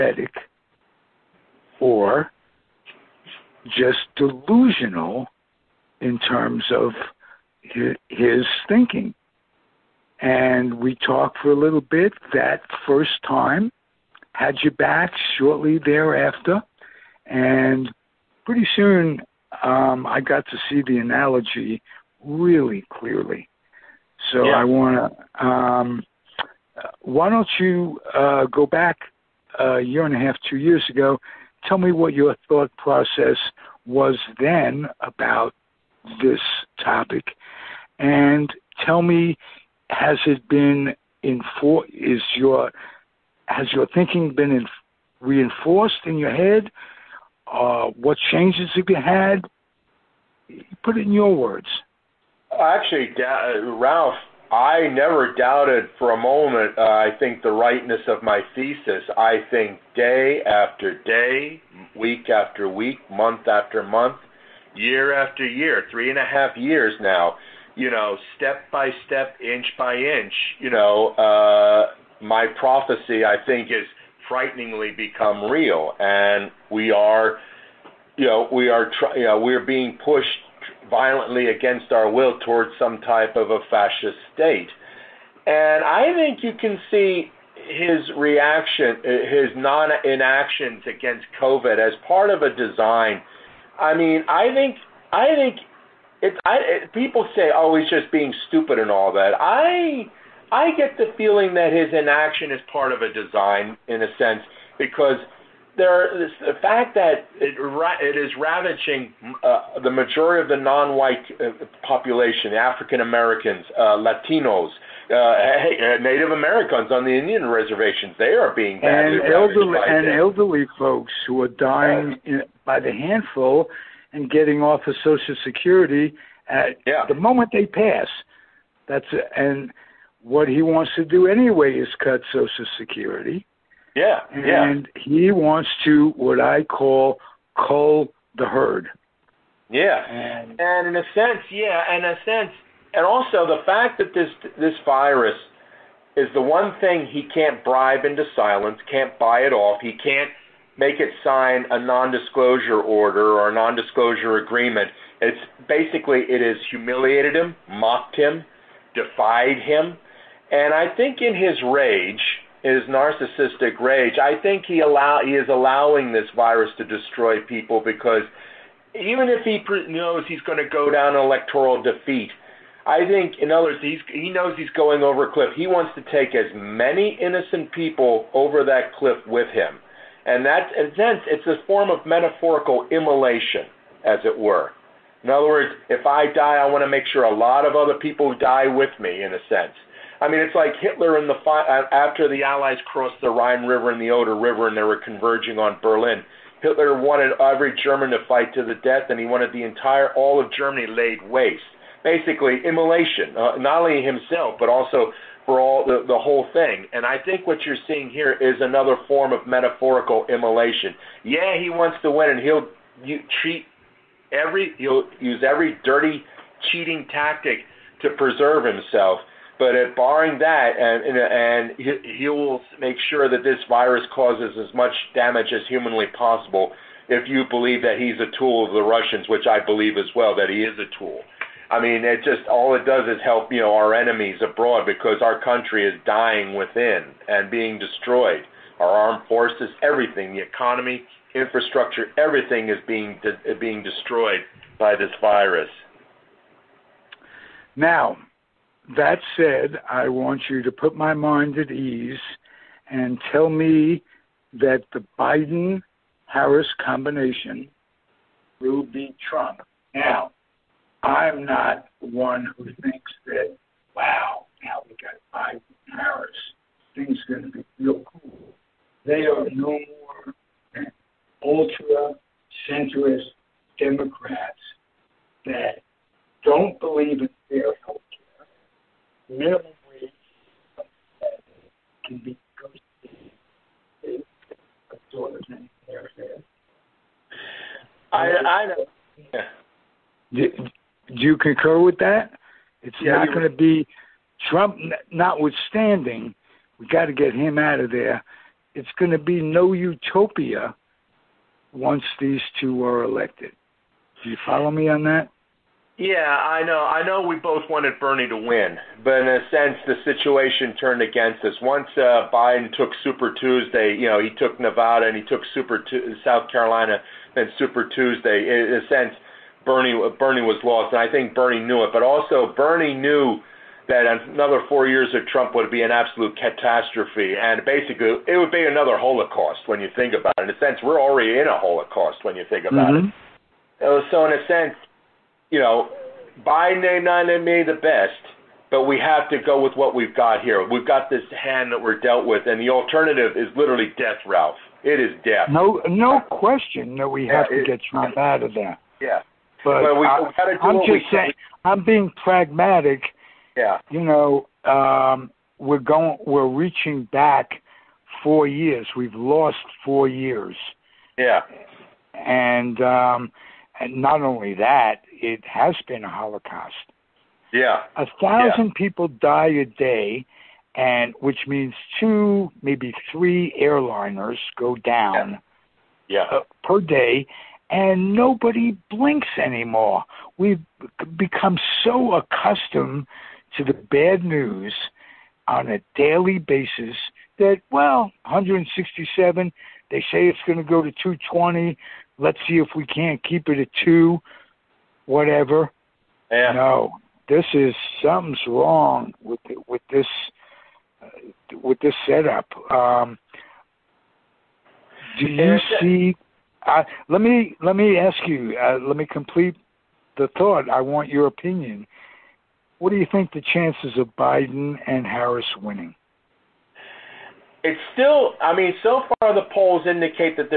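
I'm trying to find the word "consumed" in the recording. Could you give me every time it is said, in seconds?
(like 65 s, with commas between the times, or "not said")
not said.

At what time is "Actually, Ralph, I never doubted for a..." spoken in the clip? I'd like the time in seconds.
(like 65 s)
52 s.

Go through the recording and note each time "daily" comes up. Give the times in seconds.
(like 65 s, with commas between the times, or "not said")
385 s.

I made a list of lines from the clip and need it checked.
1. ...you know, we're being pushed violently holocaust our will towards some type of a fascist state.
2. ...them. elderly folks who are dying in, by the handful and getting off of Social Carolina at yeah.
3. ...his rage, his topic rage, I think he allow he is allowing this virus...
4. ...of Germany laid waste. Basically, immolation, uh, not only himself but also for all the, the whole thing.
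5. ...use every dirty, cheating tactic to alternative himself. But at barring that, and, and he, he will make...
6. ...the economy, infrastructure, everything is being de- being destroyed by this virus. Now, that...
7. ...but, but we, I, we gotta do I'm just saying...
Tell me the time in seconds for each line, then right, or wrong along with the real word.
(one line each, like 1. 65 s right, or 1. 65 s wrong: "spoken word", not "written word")
1. 79 s wrong: "against", not "holocaust"
2. 120 s wrong: "Security", not "Carolina"
3. 161 s wrong: "narcissistic", not "topic"
4. 200 s right
5. 215 s wrong: "preserve", not "alternative"
6. 240 s right
7. 349 s right.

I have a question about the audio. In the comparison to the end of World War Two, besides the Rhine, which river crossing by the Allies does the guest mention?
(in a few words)
Oder River.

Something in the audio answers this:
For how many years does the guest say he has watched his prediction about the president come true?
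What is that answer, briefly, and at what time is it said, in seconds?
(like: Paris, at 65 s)
3.5 years, at 65 s.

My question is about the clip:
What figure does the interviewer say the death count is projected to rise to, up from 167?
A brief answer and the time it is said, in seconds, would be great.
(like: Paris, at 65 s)
220, at 390 s.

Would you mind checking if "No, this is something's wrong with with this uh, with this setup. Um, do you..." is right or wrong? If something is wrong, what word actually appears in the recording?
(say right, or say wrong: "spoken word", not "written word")
right.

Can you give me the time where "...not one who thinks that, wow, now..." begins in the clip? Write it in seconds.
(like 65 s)
261 s.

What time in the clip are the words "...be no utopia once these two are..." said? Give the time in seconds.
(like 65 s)
299 s.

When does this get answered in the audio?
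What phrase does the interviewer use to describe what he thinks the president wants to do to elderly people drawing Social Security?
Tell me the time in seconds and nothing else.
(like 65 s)
137 s.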